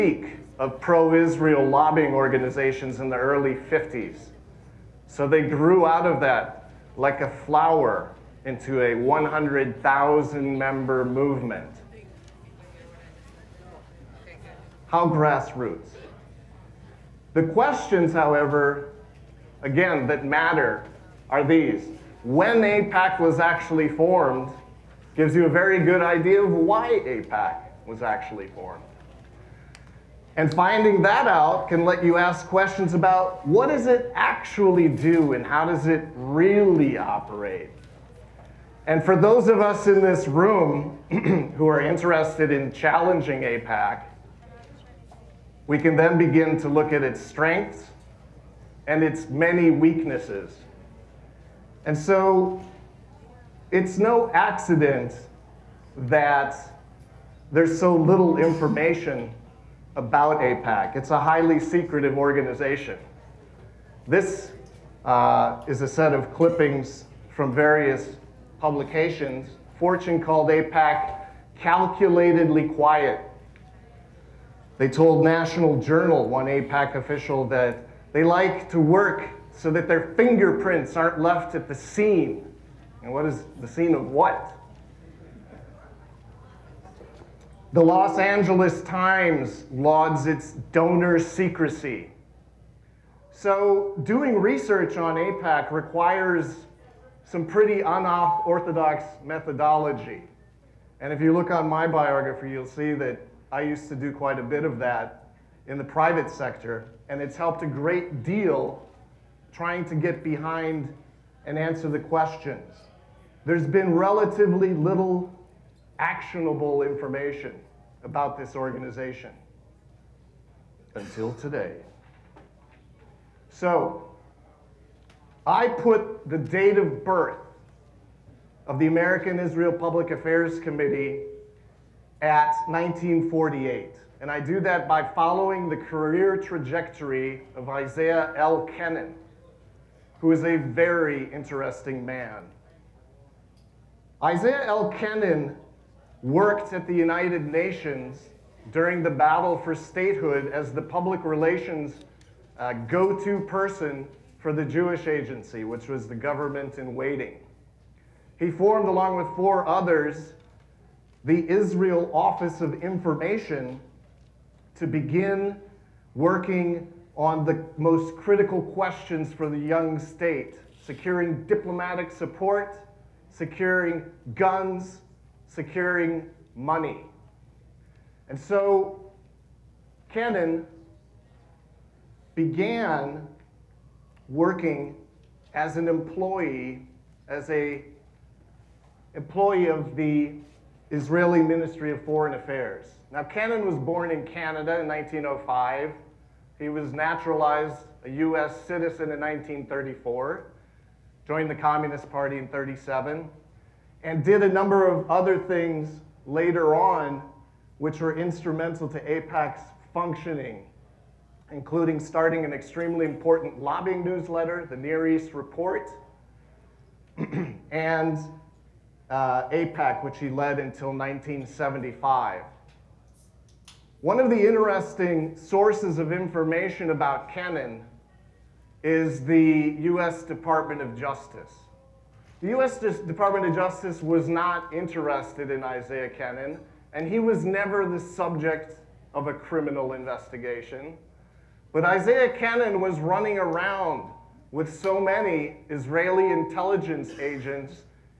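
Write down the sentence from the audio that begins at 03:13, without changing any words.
Now, Cannon was born in Canada in 1905.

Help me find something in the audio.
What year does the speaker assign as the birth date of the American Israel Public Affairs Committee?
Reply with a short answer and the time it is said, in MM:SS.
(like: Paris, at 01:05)
1948, at 02:12.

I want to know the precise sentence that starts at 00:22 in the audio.
When APAC was actually formed gives you a very good idea of why APAC was actually formed.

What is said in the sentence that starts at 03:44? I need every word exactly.
One of the interesting sources of information about Kenen is the US Department of Justice.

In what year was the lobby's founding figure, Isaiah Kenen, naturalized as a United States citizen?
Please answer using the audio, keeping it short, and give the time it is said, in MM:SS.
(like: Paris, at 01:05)
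1934, at 03:19.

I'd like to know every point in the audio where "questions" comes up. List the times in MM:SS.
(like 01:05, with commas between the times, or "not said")
00:17, 00:32, 01:51, 02:48.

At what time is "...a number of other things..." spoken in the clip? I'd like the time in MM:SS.
03:24.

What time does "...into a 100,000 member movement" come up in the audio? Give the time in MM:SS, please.
00:08.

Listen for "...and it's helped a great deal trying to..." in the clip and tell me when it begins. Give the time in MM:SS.
01:47.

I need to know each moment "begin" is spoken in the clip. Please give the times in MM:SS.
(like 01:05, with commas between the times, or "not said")
00:46, 02:44.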